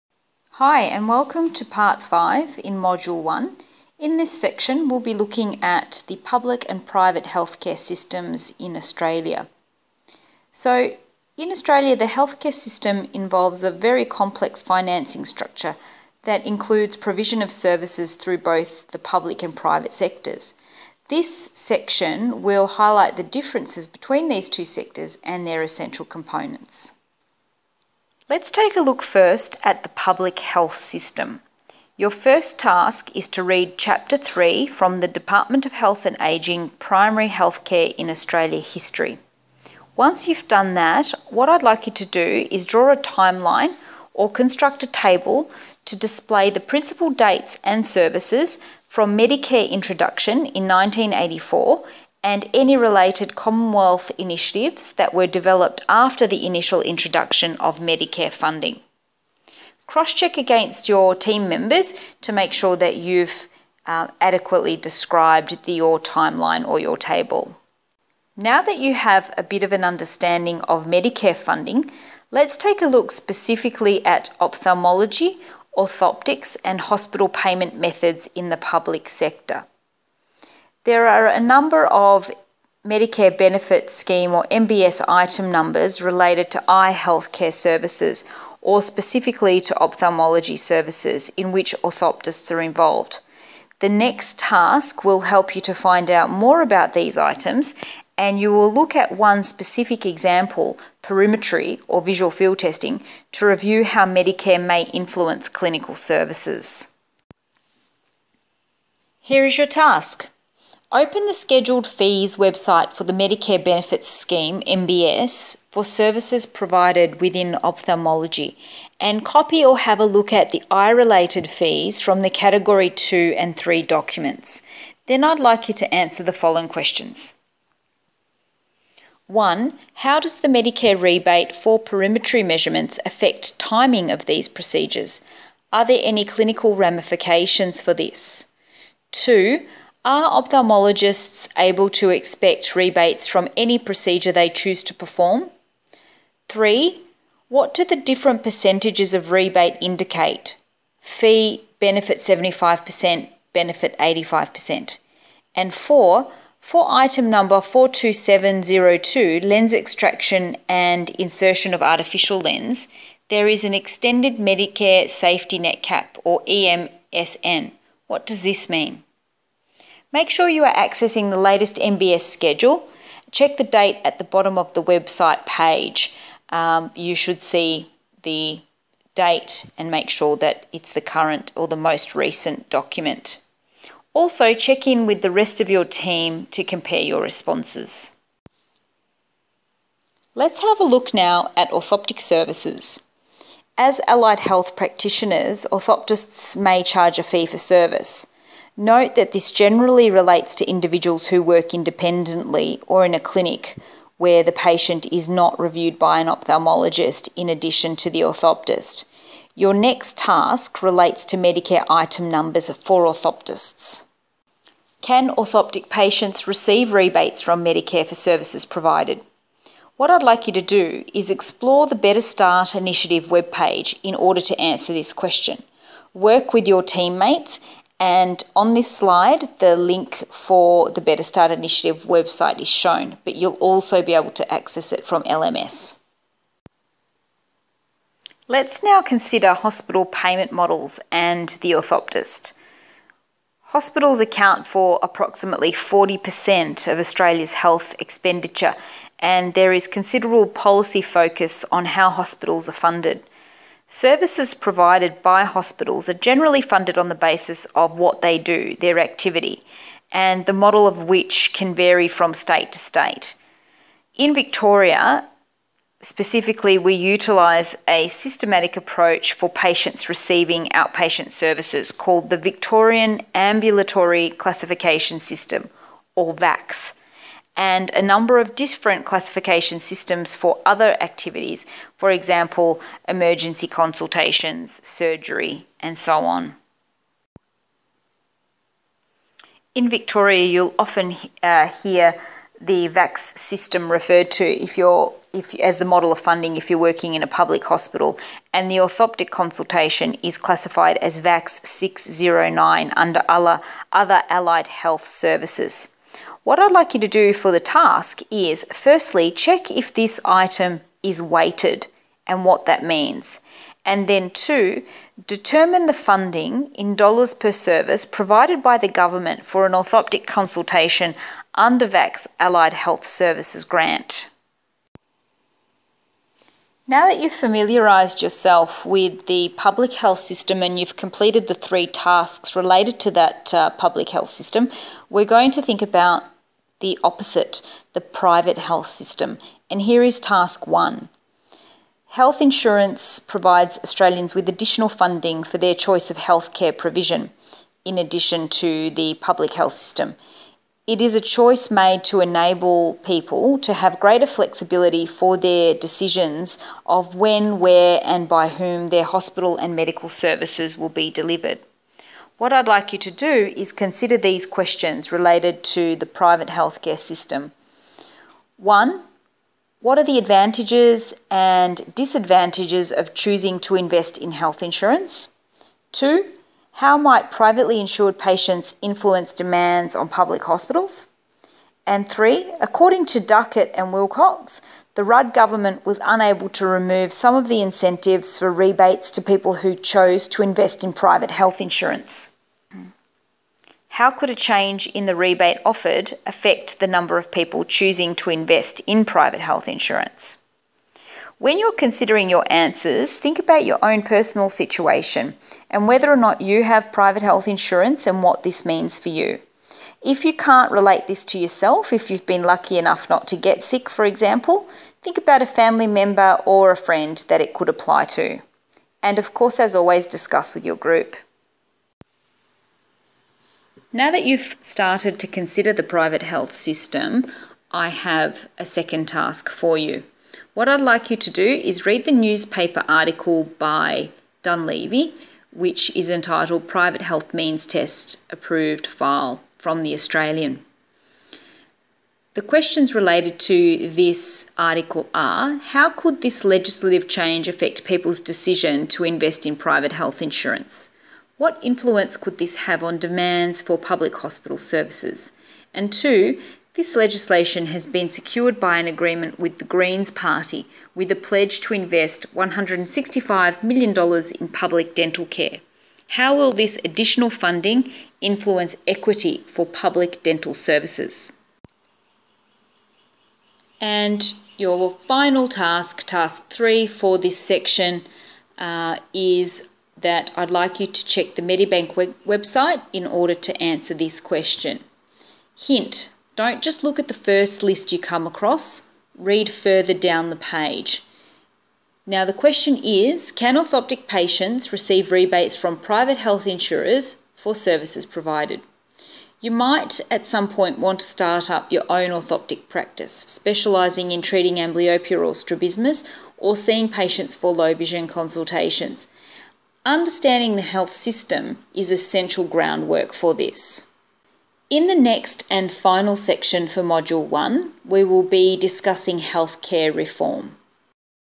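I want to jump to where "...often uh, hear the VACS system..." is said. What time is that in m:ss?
4:50.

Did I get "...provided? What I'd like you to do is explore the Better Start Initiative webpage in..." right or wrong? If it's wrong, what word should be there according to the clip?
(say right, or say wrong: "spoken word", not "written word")
right.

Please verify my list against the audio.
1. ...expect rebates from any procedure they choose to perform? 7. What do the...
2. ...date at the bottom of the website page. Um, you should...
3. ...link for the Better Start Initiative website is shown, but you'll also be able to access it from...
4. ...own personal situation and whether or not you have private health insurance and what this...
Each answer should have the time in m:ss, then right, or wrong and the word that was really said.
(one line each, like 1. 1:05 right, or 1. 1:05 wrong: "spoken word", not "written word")
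1. 2:22 wrong: "3", not "7"
2. 2:53 right
3. 3:49 right
4. 6:43 right.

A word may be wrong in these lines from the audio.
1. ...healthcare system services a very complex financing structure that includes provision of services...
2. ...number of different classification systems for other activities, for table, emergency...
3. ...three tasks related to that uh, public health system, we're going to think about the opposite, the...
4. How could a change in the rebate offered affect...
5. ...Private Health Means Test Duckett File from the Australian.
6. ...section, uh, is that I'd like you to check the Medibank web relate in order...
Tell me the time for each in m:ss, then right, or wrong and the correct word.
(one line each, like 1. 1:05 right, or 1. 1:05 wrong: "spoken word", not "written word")
1. 0:12 wrong: "involves", not "services"
2. 4:38 wrong: "example", not "table"
3. 5:31 right
4. 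6:33 right
5. 7:16 wrong: "Approved", not "Duckett"
6. 7:57 wrong: "website", not "relate".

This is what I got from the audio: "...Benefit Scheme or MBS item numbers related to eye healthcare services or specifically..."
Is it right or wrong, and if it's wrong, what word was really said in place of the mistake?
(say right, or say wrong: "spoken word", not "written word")
right.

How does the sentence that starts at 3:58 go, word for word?
Let's now consider hospital payment models and the orthoptist.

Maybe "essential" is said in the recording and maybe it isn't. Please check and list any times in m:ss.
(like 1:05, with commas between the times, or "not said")
0:25, 8:31.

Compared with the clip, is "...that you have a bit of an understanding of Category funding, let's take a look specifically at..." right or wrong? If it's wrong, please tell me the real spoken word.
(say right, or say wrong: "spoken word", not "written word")
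wrong: "Medicare", not "Category".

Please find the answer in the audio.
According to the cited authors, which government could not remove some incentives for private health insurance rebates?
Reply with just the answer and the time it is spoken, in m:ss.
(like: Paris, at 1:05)
Rudd government, at 6:25.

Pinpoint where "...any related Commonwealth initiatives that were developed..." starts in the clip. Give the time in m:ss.
0:52.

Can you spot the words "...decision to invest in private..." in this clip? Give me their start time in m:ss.
7:28.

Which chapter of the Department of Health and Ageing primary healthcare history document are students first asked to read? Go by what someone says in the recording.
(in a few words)
Chapter 3.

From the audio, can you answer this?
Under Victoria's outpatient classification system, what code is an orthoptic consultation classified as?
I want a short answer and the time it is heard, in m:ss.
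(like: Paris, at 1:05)
VACS 609, at 5:01.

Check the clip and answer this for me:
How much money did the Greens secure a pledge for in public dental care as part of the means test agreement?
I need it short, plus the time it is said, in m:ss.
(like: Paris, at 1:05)
$165 million, at 7:42.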